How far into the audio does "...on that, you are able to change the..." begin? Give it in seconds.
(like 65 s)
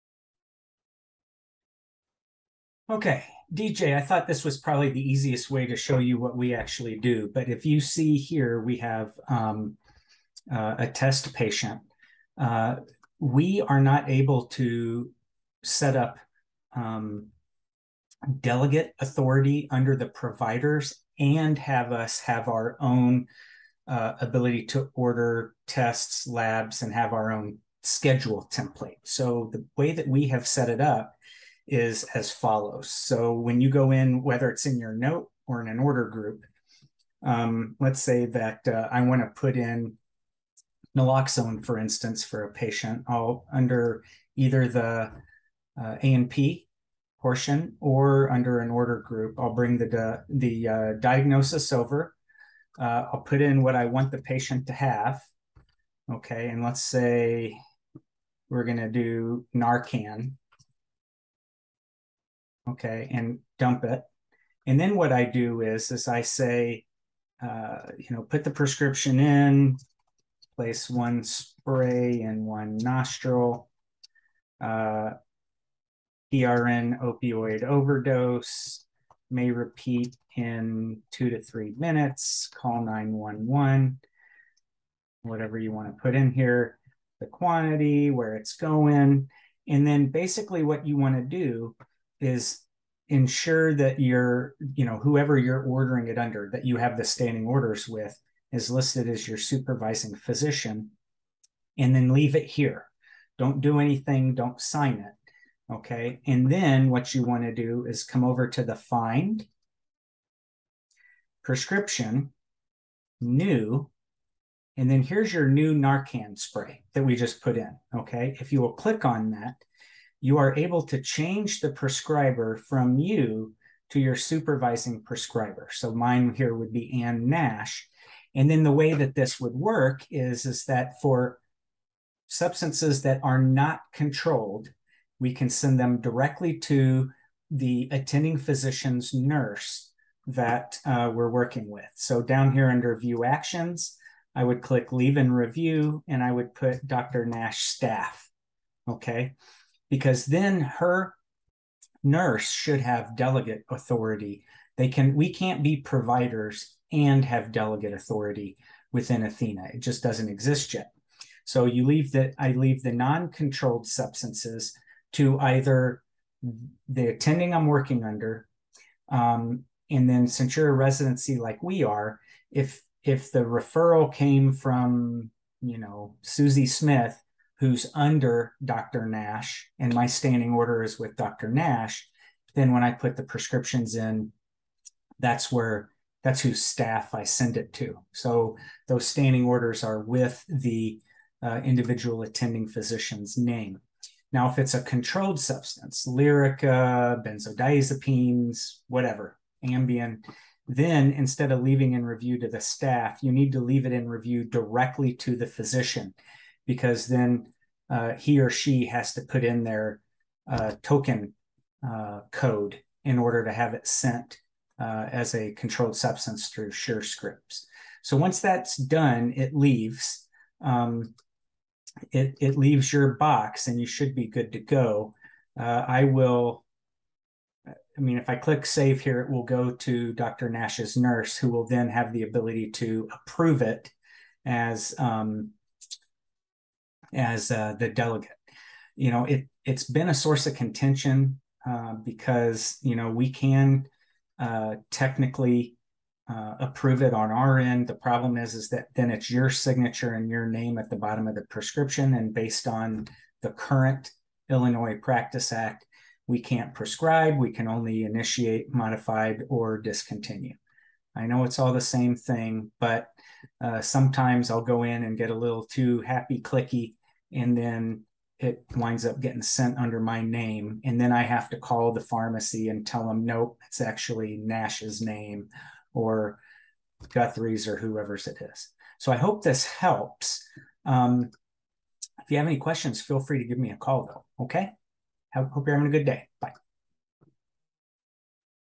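119 s.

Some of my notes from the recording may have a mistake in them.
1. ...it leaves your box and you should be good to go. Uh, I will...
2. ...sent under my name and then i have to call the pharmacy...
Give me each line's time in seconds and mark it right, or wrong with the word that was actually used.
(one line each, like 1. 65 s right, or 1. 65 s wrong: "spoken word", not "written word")
1. 222 s right
2. 269 s right.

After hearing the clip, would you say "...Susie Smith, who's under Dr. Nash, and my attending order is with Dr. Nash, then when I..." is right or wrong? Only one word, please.
wrong.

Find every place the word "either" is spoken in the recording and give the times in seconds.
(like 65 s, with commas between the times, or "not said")
44 s, 165 s.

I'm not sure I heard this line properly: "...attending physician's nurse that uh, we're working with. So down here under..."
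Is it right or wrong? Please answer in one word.
right.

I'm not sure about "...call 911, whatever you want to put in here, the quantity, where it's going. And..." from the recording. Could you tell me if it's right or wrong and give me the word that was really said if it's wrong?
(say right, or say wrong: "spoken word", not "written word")
right.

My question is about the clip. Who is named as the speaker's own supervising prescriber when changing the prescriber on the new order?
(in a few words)
Ann Nash.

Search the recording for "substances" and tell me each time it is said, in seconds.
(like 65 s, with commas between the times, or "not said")
132 s, 163 s, 195 s, 215 s.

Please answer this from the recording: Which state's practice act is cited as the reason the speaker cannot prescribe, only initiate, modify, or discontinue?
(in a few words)
Illinois.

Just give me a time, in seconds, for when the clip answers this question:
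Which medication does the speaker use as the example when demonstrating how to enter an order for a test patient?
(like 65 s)
40 s.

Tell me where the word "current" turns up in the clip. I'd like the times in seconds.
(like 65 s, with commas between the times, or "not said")
253 s.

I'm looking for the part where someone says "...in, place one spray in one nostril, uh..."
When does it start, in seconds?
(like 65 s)
69 s.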